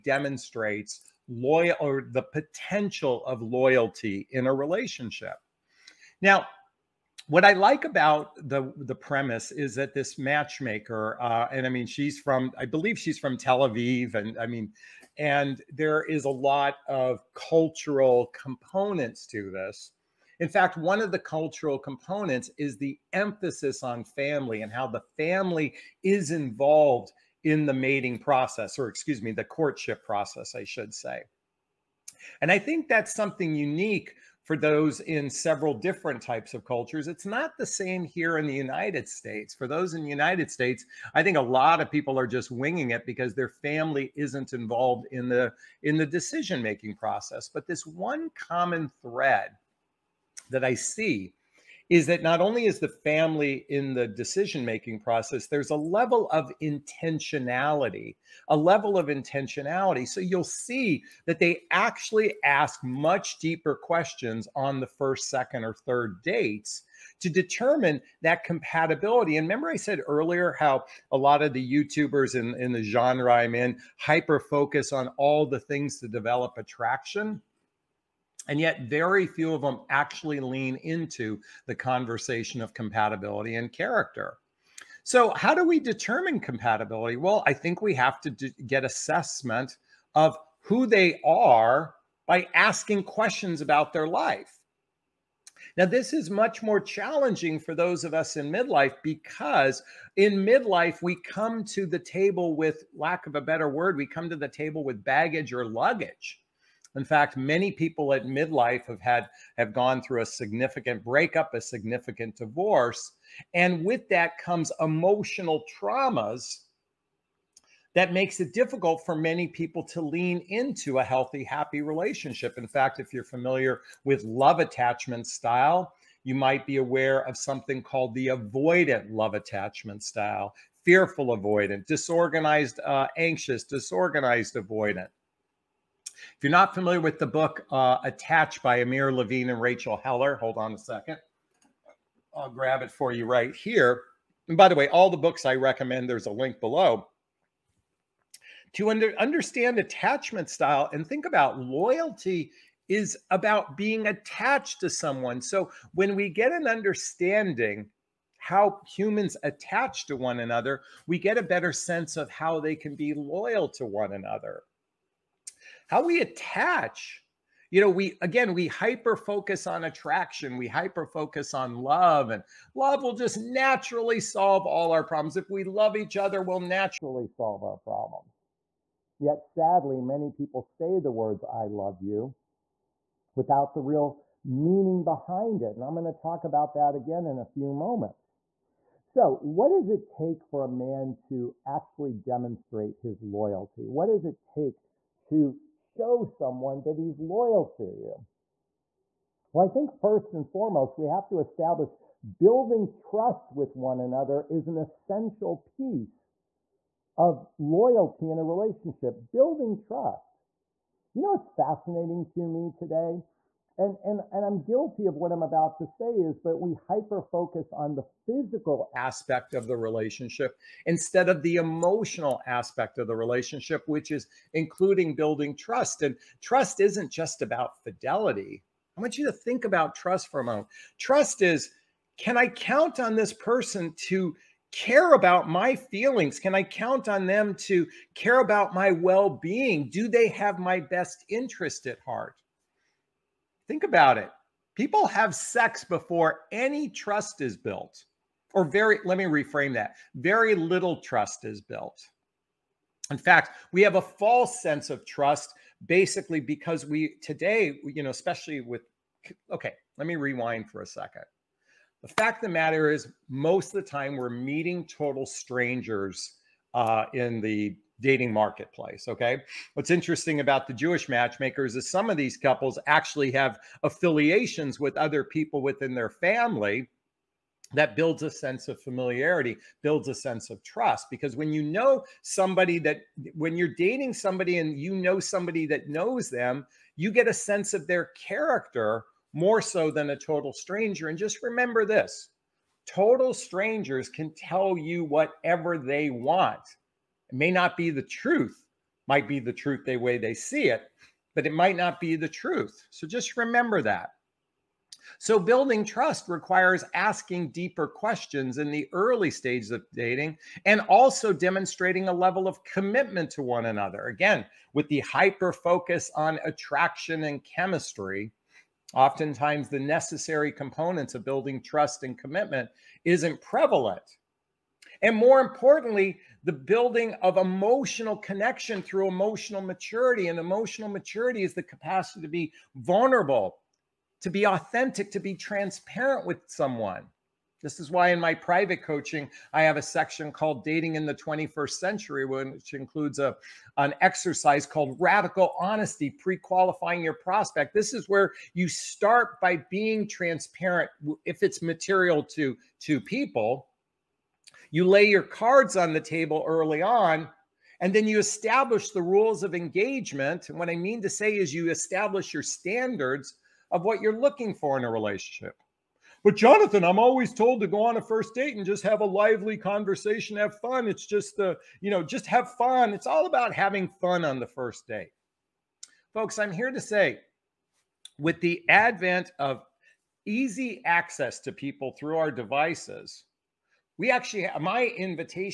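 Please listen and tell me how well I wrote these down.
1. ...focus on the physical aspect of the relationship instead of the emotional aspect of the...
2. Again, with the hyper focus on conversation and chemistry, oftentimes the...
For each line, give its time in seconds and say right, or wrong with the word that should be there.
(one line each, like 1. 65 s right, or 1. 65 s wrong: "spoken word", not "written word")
1. 217 s right
2. 314 s wrong: "attraction", not "conversation".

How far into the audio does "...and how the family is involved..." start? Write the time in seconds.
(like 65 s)
24 s.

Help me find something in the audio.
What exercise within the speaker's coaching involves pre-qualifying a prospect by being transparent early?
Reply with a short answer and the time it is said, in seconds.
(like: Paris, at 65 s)
Radical Honesty, at 344 s.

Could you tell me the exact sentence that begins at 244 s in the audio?
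People have sex before any trust is built, or very, let me reframe that very little trust is built.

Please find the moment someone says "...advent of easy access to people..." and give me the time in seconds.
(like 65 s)
378 s.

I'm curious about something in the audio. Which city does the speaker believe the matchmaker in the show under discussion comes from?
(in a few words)
Tel Aviv.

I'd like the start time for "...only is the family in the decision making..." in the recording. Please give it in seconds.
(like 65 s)
52 s.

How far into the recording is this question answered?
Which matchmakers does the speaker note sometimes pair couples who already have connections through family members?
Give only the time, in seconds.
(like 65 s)
270 s.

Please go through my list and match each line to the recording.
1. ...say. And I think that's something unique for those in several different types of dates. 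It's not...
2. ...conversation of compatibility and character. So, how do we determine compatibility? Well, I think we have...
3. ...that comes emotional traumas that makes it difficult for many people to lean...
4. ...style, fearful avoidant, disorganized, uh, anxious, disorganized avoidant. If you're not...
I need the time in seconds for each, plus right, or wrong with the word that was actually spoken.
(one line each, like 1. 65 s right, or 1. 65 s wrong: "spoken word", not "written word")
1. 30 s wrong: "cultures", not "dates"
2. 81 s right
3. 114 s right
4. 130 s right.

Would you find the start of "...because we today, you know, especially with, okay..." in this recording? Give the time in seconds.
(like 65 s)
256 s.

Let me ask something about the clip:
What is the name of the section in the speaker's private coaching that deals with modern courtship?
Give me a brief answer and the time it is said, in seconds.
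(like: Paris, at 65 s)
Dating in the 21st Century, at 340 s.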